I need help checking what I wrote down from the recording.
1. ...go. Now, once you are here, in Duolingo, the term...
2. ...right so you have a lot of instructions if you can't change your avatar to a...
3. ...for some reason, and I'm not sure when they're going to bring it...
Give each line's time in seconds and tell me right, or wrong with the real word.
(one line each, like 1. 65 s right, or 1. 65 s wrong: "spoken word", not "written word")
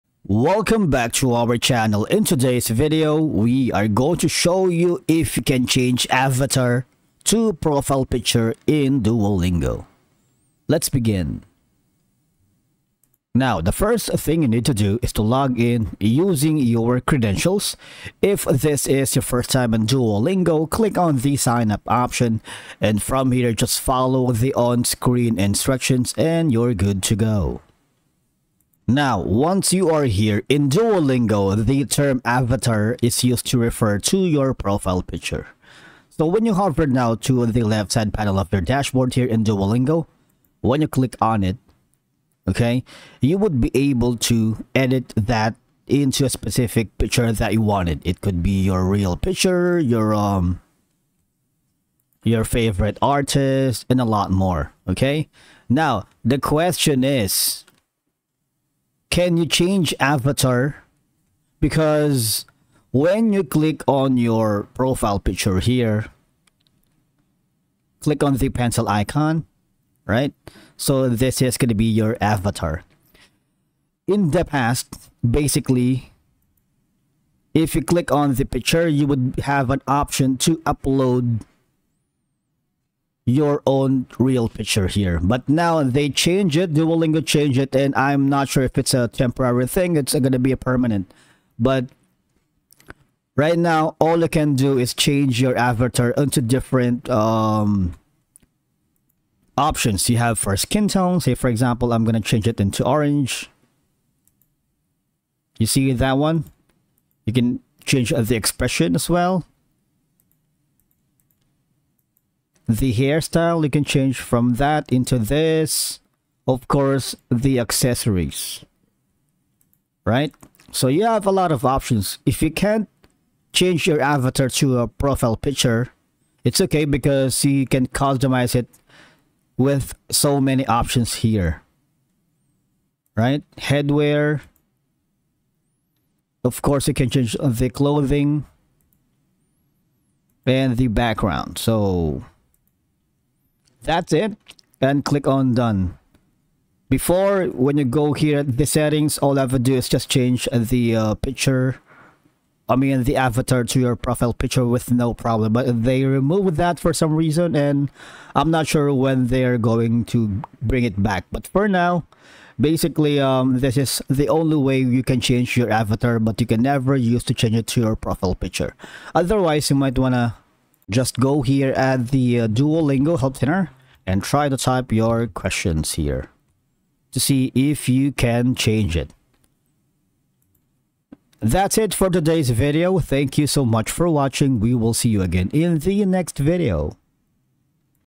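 1. 27 s right
2. 120 s wrong: "options", not "instructions"
3. 156 s right.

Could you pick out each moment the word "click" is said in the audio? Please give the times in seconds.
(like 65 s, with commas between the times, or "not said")
20 s, 40 s, 63 s, 67 s, 77 s, 145 s.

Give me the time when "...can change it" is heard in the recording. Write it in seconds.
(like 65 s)
178 s.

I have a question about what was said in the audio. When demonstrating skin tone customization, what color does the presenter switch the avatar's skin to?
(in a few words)
orange.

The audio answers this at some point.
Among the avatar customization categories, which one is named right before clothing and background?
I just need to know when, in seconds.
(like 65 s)
133 s.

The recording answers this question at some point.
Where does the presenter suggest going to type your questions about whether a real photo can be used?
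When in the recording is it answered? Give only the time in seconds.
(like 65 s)
172 s.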